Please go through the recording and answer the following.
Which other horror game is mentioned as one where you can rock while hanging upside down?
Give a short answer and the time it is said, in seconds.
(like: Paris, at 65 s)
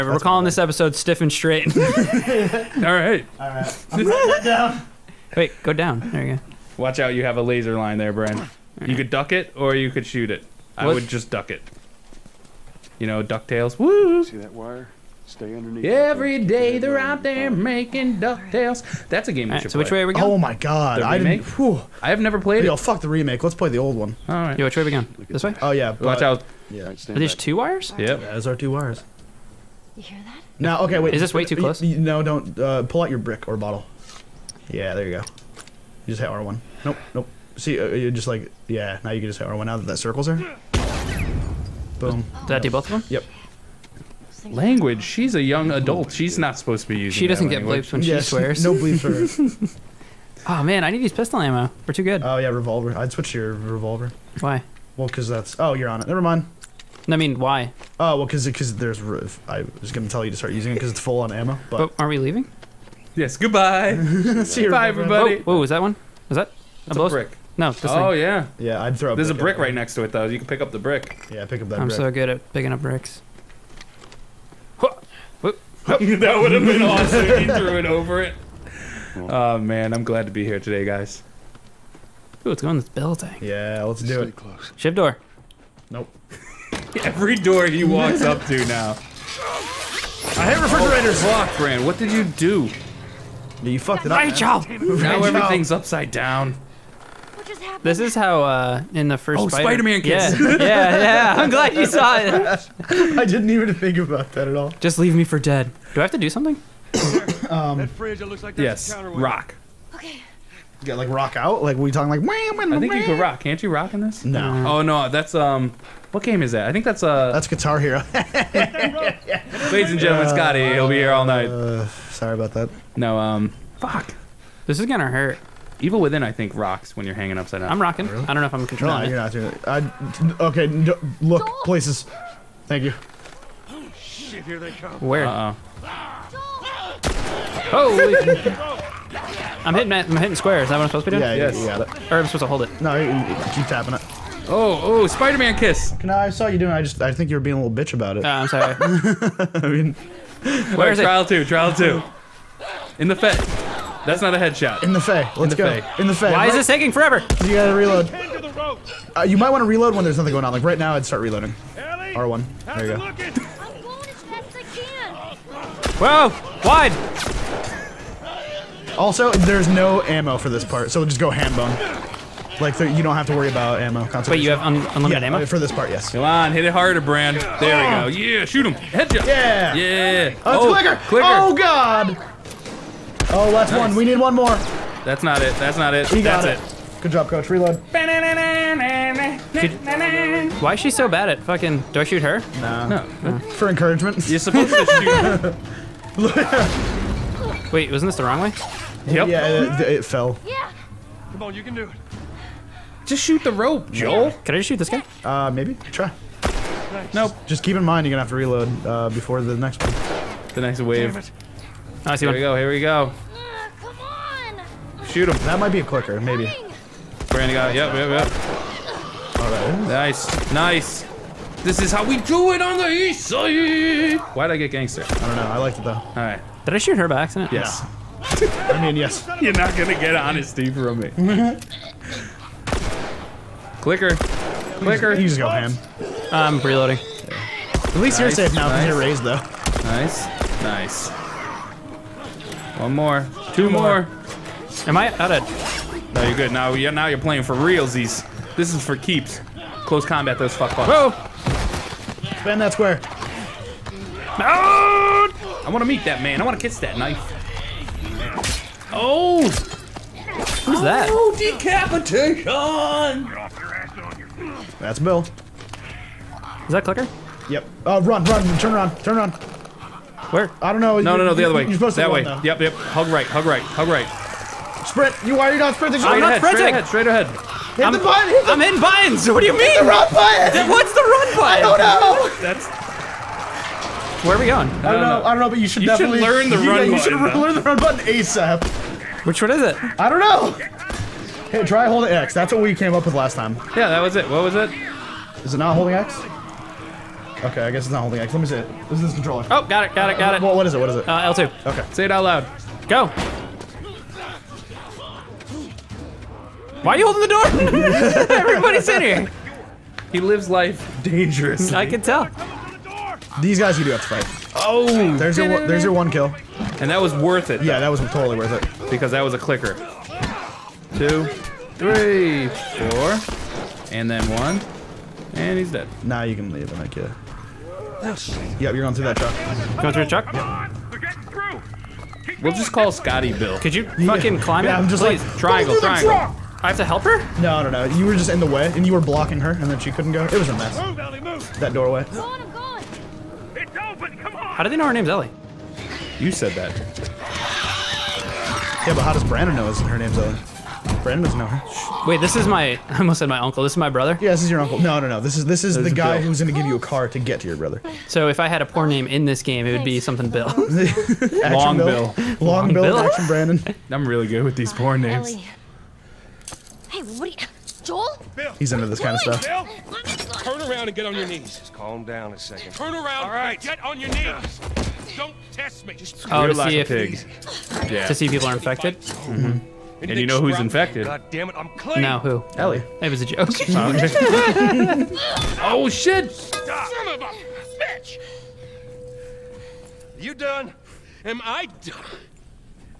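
Evil Within, at 125 s.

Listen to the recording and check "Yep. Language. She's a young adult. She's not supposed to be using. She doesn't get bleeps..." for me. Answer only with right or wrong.
right.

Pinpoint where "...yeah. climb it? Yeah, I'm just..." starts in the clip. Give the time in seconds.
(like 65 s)
334 s.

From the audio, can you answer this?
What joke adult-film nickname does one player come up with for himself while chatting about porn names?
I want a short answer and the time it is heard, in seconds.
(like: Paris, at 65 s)
Action Brandon, at 362 s.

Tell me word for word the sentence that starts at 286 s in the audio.
You should button, learn the run button ASAP.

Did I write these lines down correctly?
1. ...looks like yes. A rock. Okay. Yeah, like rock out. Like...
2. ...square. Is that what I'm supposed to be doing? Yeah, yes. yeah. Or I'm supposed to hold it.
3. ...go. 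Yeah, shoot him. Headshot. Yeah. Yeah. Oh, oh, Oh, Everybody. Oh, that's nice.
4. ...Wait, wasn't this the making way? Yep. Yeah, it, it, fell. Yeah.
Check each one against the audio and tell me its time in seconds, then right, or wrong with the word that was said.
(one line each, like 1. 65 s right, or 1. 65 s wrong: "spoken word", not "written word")
1. 108 s right
2. 140 s right
3. 178 s wrong: "God", not "Everybody"
4. 197 s wrong: "wrong", not "making".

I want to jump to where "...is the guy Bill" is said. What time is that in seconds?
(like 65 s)
355 s.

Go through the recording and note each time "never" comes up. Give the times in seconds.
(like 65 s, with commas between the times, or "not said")
22 s, 56 s.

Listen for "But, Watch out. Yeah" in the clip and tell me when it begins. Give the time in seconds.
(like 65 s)
25 s.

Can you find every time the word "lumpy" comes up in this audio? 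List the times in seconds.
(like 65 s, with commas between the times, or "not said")
not said.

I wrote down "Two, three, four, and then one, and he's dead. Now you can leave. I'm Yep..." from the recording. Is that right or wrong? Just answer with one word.
right.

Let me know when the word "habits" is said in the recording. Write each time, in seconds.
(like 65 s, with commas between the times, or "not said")
not said.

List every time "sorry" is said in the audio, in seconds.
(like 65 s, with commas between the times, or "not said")
122 s, 148 s.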